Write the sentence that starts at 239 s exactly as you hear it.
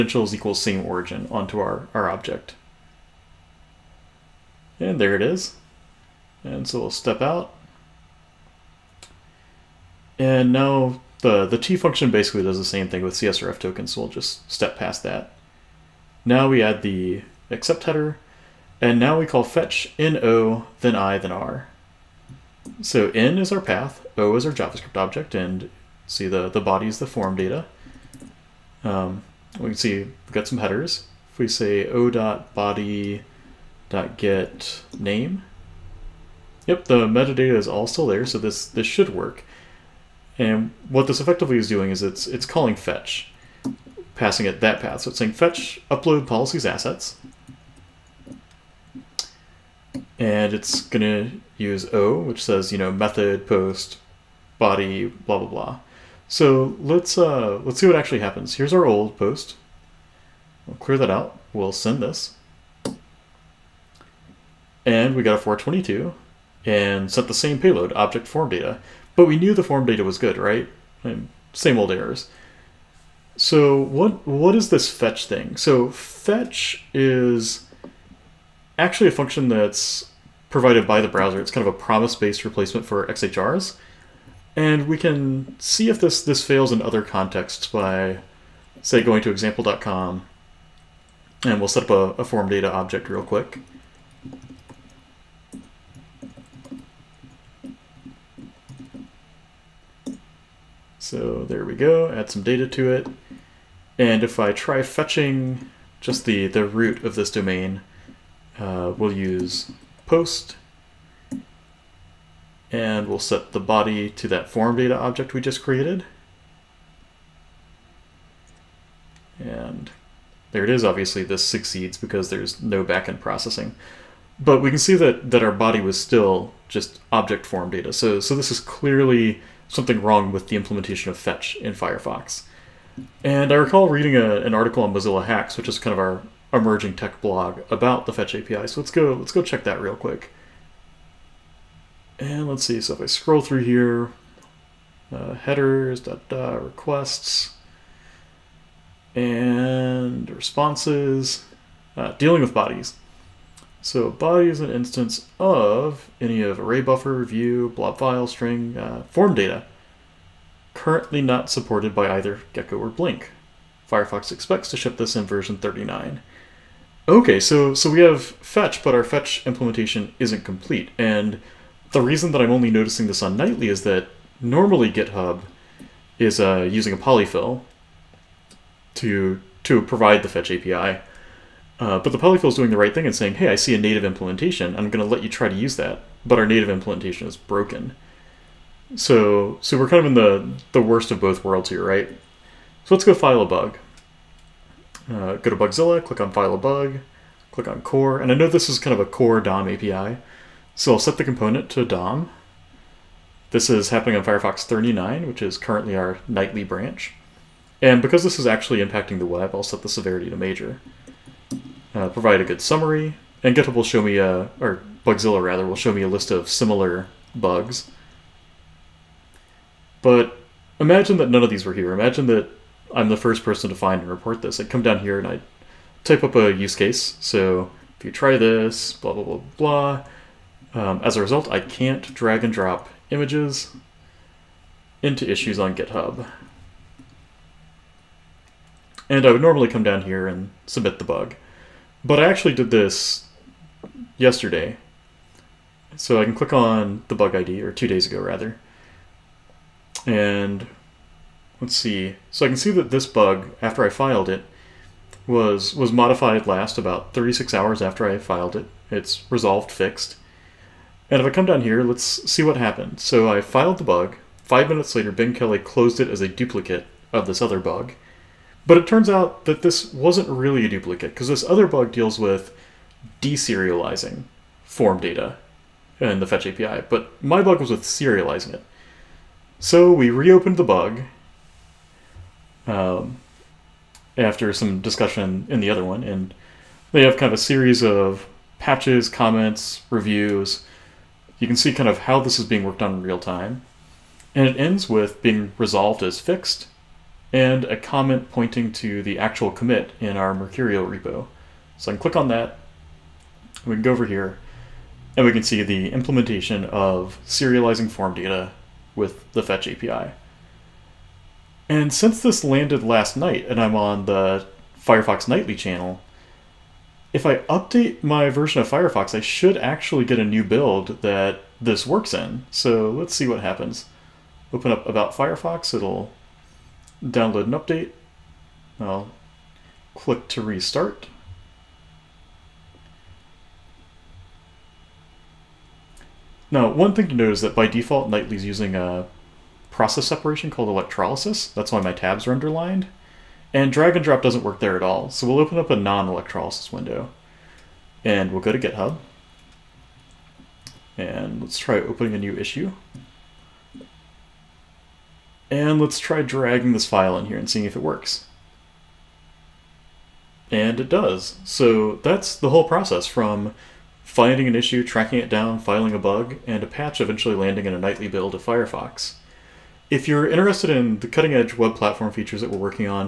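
And I would normally come down here and submit the bug.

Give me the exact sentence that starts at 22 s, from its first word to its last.
So N is our path, O is our JavaScript object, and see the, the body is the form data.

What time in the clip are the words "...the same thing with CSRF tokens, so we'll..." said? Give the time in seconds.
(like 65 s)
12 s.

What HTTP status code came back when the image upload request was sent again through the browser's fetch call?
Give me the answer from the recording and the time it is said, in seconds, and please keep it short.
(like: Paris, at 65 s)
422, at 65 s.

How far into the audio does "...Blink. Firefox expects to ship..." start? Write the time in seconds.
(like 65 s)
162 s.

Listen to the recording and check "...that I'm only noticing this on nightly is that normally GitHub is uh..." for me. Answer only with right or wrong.
right.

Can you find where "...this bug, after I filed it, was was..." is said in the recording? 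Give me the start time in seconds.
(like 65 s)
252 s.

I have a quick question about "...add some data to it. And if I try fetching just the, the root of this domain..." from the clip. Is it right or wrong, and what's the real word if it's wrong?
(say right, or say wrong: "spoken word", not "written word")
right.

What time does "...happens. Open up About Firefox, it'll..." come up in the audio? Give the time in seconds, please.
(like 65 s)
323 s.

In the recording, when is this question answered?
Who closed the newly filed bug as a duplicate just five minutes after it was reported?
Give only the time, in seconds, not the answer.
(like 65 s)
265 s.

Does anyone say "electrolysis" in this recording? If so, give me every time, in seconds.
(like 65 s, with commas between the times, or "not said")
340 s, 345 s.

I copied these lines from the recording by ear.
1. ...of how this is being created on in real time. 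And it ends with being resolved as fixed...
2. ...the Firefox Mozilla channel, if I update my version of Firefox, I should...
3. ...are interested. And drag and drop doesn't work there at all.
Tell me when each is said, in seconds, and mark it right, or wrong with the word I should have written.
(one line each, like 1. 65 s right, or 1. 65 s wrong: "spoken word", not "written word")
1. 291 s wrong: "worked", not "created"
2. 314 s wrong: "Nightly", not "Mozilla"
3. 342 s wrong: "underlined", not "interested".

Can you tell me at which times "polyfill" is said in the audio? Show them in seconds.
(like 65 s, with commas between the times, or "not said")
176 s, 182 s.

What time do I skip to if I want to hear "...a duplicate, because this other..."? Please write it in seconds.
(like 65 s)
270 s.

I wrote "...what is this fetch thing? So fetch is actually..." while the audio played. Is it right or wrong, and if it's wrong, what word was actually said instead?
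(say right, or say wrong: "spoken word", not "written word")
right.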